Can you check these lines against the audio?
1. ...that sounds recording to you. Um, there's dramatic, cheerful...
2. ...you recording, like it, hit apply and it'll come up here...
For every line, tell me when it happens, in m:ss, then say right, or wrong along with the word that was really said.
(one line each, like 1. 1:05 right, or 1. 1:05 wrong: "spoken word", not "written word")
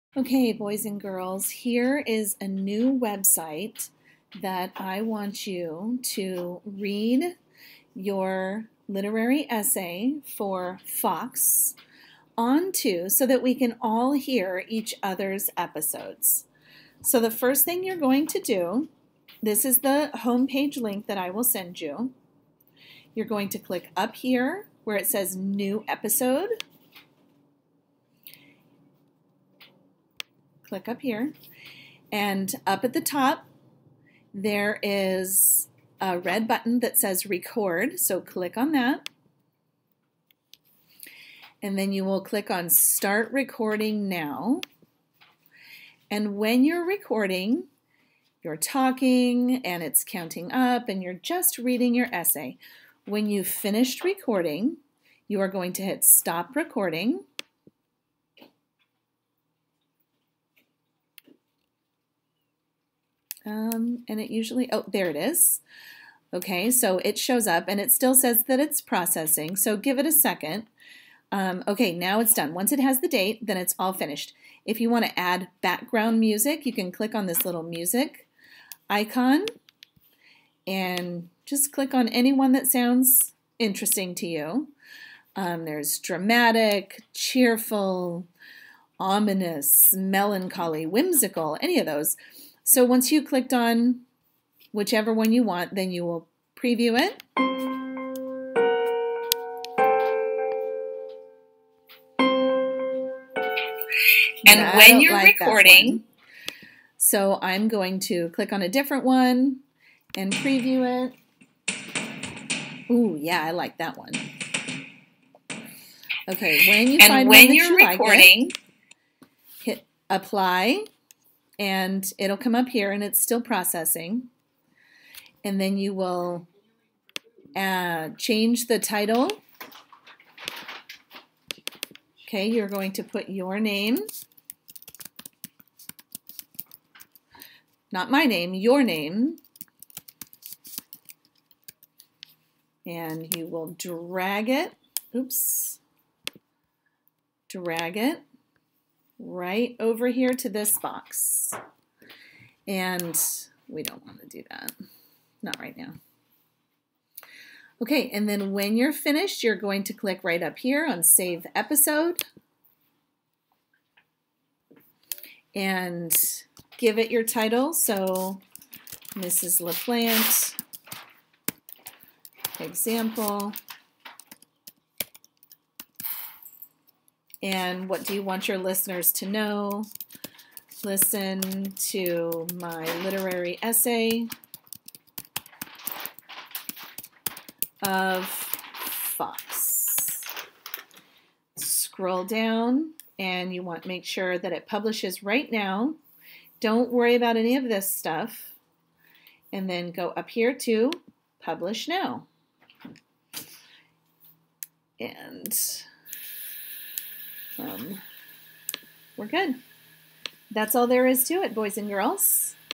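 1. 1:22 wrong: "interesting", not "recording"
2. 1:57 right.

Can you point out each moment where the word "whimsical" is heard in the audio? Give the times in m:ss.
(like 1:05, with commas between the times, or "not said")
1:30.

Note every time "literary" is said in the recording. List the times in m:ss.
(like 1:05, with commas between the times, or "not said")
0:08, 3:03.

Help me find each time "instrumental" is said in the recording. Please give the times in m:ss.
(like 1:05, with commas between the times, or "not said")
not said.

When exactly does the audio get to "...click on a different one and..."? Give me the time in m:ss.
1:48.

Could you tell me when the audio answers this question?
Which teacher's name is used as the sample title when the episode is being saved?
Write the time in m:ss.
2:49.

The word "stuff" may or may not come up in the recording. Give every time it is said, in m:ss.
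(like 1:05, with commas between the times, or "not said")
3:17.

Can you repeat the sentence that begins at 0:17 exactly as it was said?
So the first thing you're going to do, this is the homepage link that I will send you.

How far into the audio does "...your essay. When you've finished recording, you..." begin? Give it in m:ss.
0:51.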